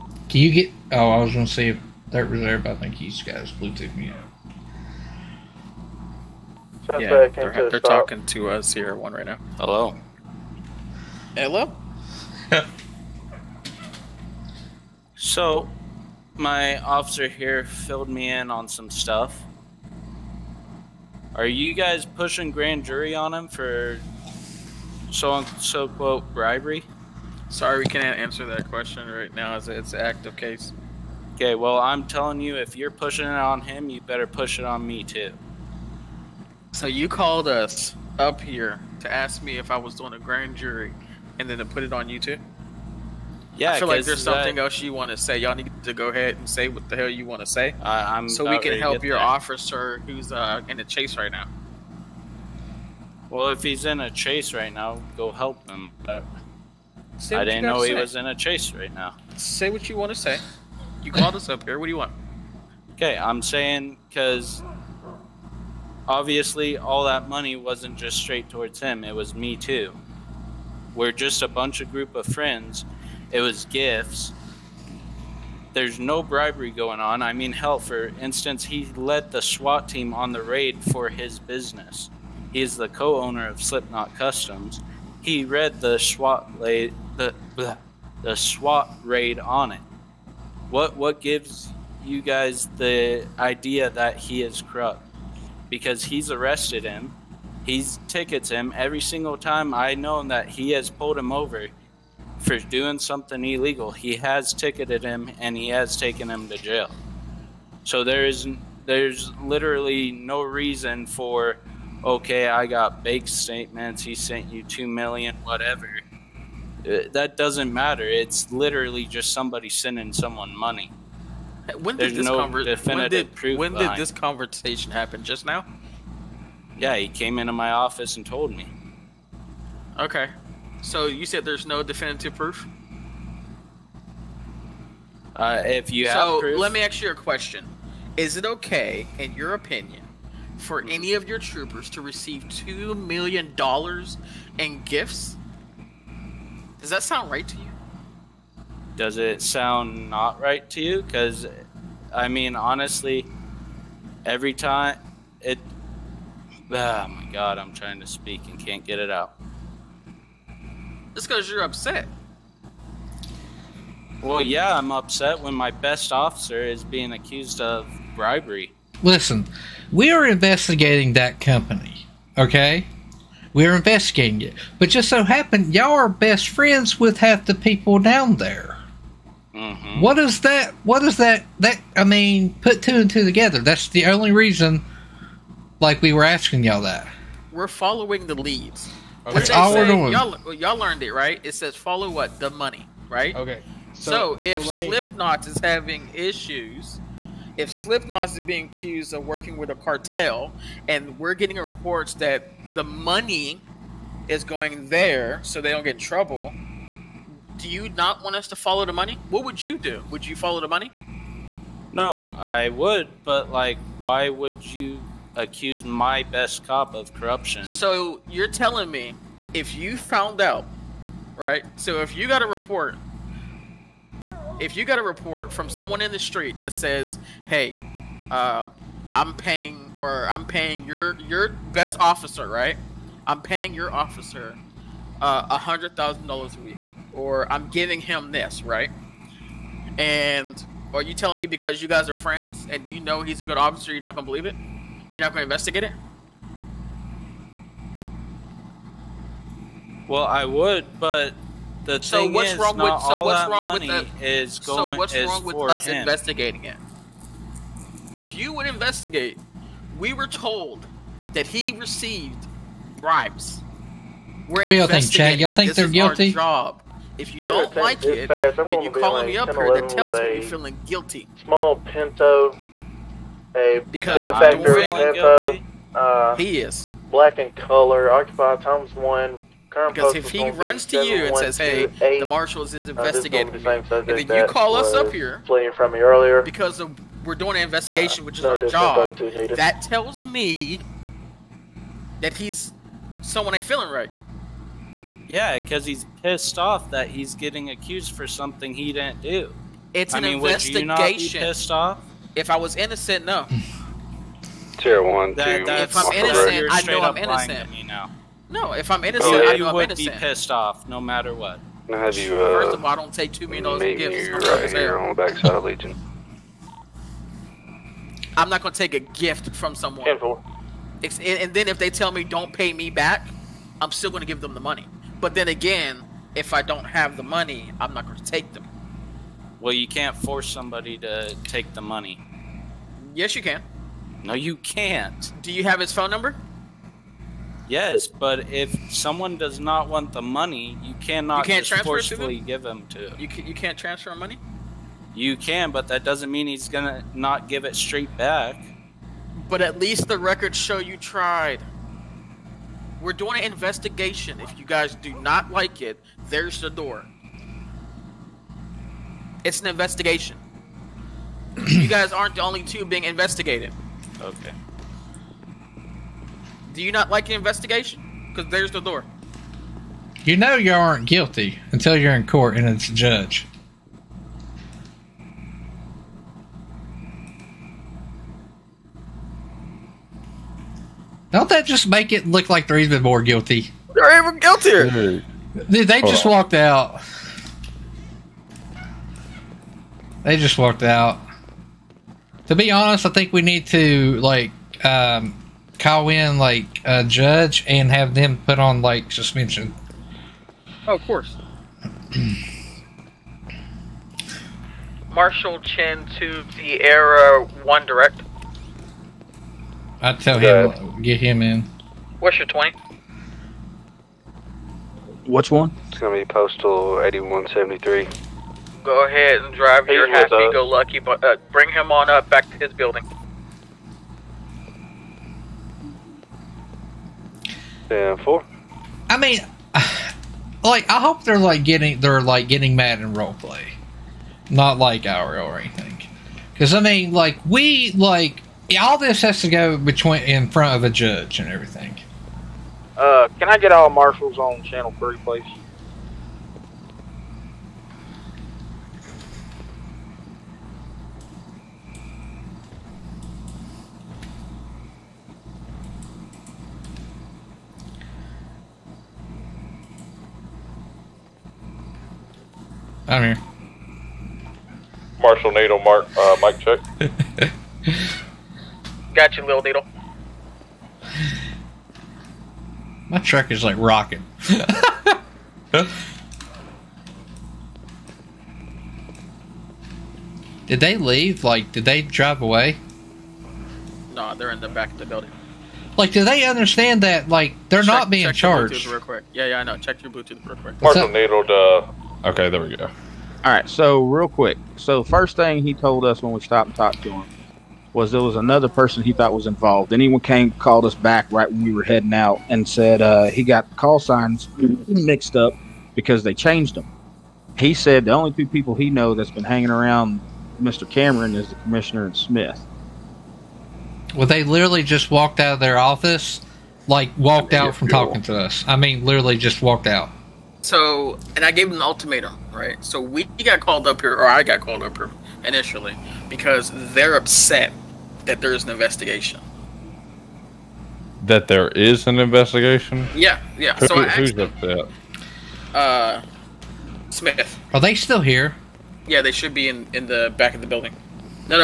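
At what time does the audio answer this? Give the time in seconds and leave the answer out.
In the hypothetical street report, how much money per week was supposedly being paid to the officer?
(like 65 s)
235 s.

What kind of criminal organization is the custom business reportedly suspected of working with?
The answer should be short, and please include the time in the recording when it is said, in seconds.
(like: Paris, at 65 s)
A cartel, at 199 s.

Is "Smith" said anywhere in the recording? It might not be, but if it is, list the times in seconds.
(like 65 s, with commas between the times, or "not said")
512 s, 537 s.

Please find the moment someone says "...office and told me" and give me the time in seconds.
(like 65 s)
127 s.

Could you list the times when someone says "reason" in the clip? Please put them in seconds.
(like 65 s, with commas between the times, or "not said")
110 s, 184 s.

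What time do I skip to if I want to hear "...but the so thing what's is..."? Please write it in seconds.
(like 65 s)
250 s.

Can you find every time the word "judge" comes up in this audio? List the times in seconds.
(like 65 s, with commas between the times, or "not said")
372 s, 397 s, 440 s.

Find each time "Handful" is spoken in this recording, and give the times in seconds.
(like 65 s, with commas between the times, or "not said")
320 s.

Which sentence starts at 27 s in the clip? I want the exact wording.
Sorry, we can't answer that question right now as it's an active case.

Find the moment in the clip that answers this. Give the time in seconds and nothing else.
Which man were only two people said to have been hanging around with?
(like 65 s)
510 s.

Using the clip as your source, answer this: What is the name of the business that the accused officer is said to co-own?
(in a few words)
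Slipknot Customs.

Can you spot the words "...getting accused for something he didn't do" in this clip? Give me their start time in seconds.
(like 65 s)
297 s.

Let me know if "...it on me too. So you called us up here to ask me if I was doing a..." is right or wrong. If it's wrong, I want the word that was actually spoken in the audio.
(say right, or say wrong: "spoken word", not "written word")
right.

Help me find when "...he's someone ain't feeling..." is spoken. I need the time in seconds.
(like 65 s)
292 s.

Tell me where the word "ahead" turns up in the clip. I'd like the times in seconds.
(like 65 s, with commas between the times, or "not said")
46 s, 419 s.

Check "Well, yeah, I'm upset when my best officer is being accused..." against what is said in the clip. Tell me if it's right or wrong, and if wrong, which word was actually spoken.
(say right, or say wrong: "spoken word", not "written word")
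right.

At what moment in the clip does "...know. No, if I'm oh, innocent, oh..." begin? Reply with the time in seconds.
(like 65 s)
307 s.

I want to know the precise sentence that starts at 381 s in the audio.
Don't that just make it look like they're even more guilty?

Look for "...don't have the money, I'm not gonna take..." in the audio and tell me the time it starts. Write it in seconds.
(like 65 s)
326 s.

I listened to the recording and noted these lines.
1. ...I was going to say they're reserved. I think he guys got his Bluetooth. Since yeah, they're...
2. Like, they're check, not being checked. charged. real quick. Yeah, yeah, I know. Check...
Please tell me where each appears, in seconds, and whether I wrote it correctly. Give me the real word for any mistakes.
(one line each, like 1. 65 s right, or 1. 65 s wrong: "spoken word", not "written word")
1. 1 s right
2. 487 s right.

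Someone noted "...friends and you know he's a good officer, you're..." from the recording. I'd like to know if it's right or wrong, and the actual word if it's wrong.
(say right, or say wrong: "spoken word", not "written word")
right.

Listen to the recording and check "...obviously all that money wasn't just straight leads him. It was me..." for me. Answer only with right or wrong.
wrong.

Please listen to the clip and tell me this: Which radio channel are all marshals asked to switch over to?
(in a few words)
Channel 3.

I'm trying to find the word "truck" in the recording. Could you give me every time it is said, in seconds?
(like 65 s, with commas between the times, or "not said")
473 s.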